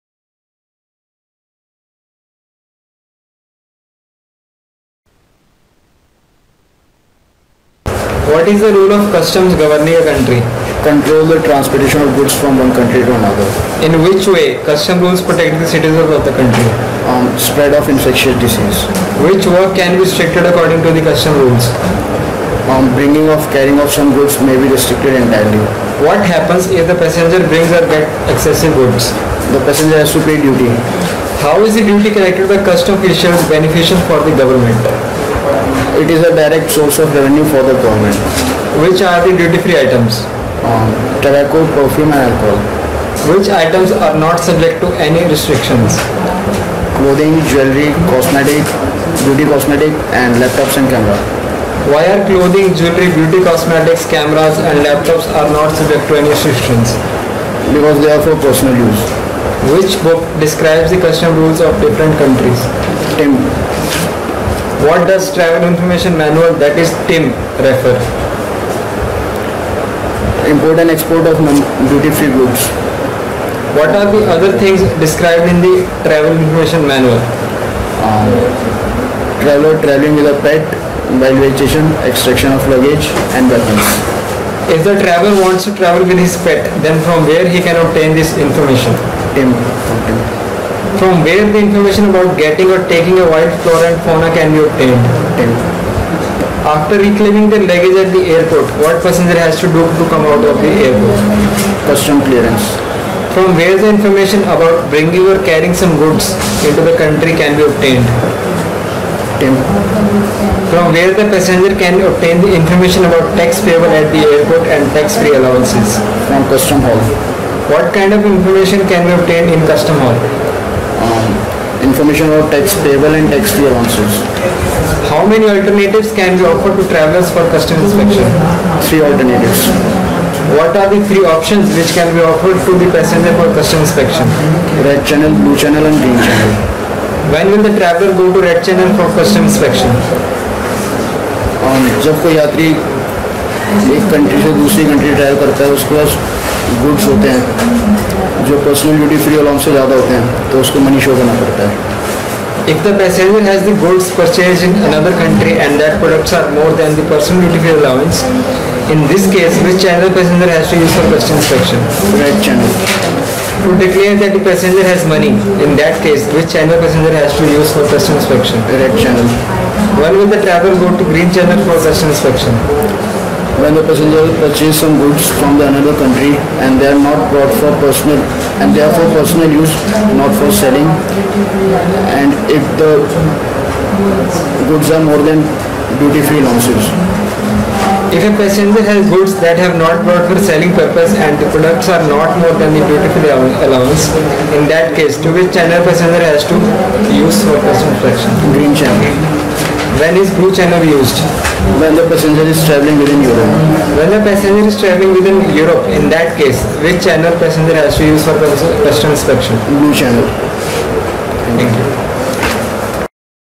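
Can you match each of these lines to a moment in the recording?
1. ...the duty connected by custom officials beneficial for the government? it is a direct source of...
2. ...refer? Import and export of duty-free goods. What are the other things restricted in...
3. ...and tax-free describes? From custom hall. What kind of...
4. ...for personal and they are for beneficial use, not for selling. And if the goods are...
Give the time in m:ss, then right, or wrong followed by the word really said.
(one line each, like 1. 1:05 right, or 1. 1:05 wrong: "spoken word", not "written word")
1. 0:31 right
2. 1:07 wrong: "described", not "restricted"
3. 1:54 wrong: "allowances", not "describes"
4. 2:57 wrong: "personal", not "beneficial".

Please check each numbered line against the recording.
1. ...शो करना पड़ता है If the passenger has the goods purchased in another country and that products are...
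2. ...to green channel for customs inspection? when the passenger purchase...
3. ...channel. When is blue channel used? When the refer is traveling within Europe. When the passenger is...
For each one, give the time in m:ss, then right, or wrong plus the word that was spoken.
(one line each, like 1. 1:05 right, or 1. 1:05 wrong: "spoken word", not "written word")
1. 2:31 right
2. 2:51 right
3. 3:18 wrong: "passenger", not "refer".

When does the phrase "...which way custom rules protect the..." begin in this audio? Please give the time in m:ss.
0:14.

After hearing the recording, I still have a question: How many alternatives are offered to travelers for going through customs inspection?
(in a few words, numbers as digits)
3.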